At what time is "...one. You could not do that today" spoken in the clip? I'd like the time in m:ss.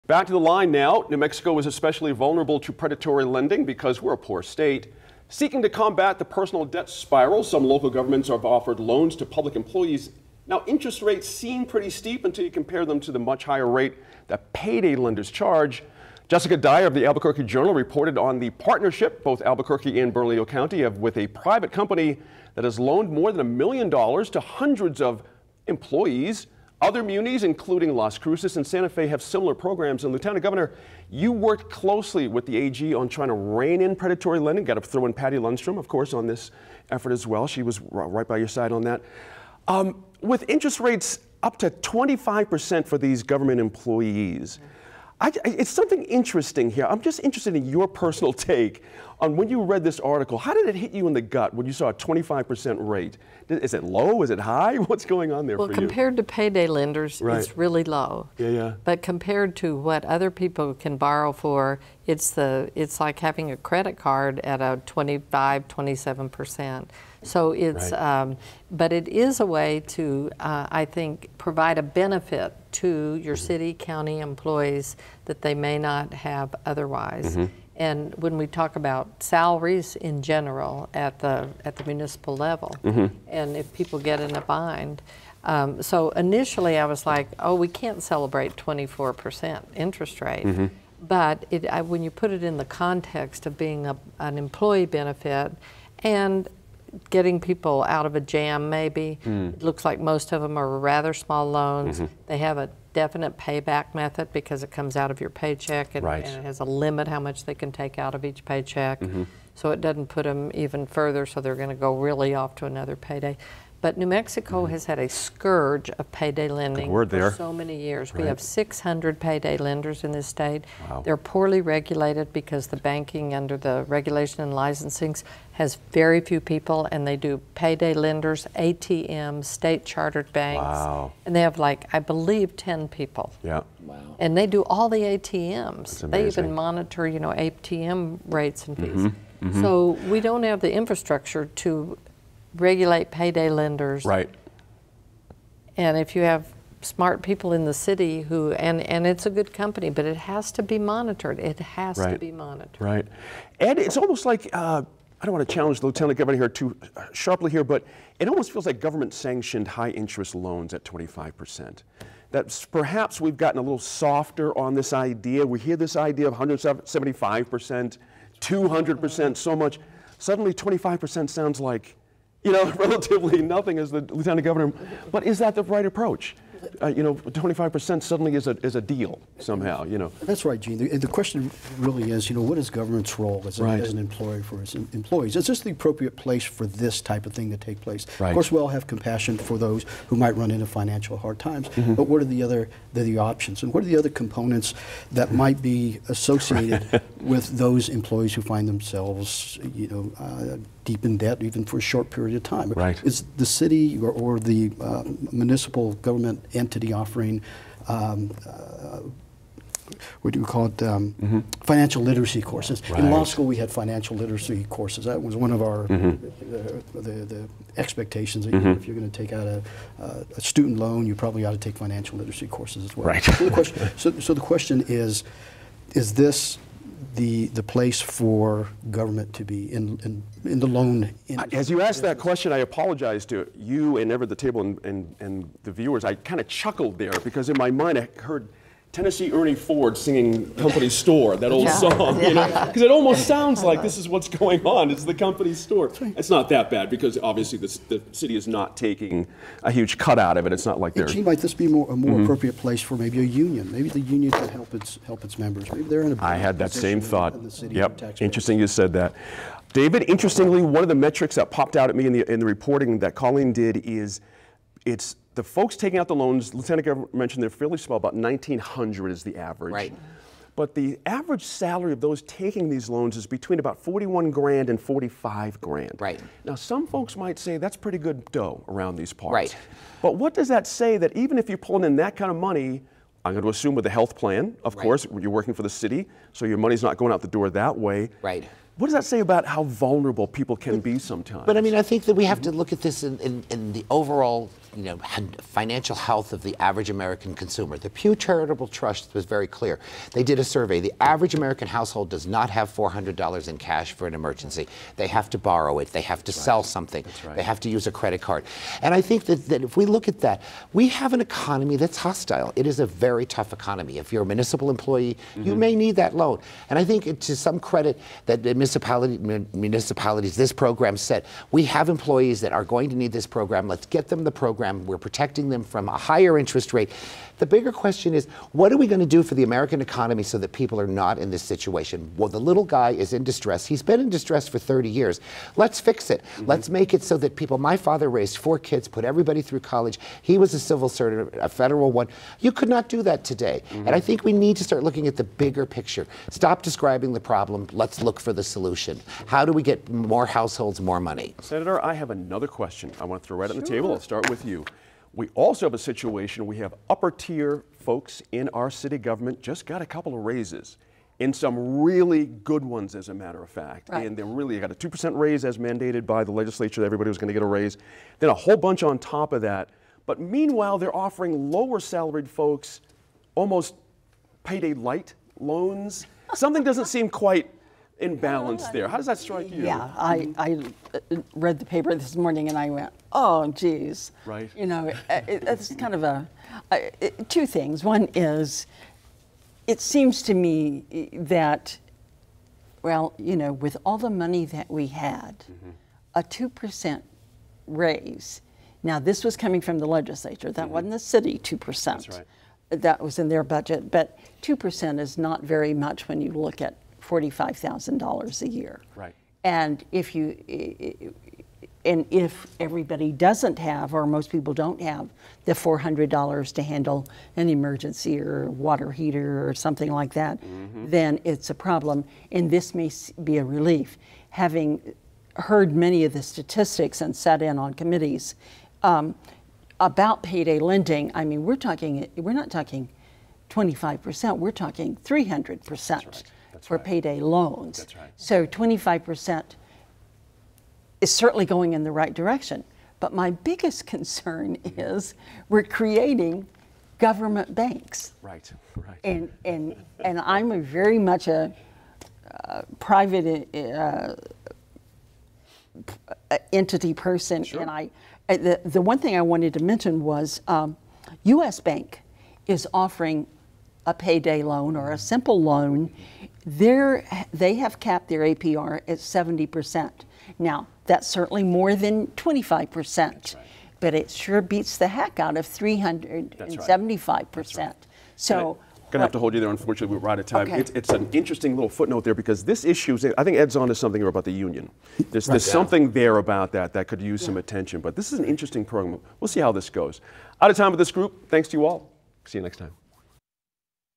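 5:41.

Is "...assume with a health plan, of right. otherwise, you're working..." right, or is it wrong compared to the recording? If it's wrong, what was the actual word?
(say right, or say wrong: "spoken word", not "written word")
wrong: "course", not "otherwise".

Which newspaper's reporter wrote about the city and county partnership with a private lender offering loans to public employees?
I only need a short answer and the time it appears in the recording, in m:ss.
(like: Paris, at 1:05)
Albuquerque Journal, at 0:17.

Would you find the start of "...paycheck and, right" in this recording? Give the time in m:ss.
1:45.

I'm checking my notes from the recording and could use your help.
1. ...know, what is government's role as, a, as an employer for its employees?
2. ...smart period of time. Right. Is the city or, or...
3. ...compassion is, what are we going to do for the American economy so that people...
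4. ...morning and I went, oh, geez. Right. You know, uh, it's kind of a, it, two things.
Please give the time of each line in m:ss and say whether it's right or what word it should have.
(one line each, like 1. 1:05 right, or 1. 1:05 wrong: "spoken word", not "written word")
1. 3:02 right
2. 3:21 wrong: "short", not "smart"
3. 5:27 wrong: "question", not "compassion"
4. 6:22 right.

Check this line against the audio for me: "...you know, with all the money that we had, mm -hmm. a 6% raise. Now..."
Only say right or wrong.
wrong.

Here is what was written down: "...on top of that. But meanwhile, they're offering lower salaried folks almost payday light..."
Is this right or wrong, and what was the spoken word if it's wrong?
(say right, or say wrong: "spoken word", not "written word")
right.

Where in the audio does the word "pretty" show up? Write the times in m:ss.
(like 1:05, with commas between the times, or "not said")
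0:11, 4:37.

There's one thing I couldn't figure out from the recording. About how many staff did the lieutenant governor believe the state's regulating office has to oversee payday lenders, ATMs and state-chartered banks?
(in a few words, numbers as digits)
10.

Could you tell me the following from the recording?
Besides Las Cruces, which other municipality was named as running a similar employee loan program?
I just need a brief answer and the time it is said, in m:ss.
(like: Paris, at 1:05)
Santa Fe, at 0:28.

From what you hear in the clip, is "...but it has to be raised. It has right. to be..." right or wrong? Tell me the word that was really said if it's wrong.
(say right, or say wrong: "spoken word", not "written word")
wrong: "monitored", not "raised".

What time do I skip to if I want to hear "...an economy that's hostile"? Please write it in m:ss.
5:11.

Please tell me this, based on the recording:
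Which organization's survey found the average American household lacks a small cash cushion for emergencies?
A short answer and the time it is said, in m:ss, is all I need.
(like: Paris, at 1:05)
Pew Charitable Trust, at 4:57.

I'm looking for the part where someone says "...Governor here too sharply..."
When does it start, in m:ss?
2:36.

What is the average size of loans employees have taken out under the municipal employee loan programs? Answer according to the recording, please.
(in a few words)
1,900.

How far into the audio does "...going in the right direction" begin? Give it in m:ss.
7:21.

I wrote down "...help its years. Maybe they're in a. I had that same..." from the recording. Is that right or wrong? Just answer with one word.
wrong.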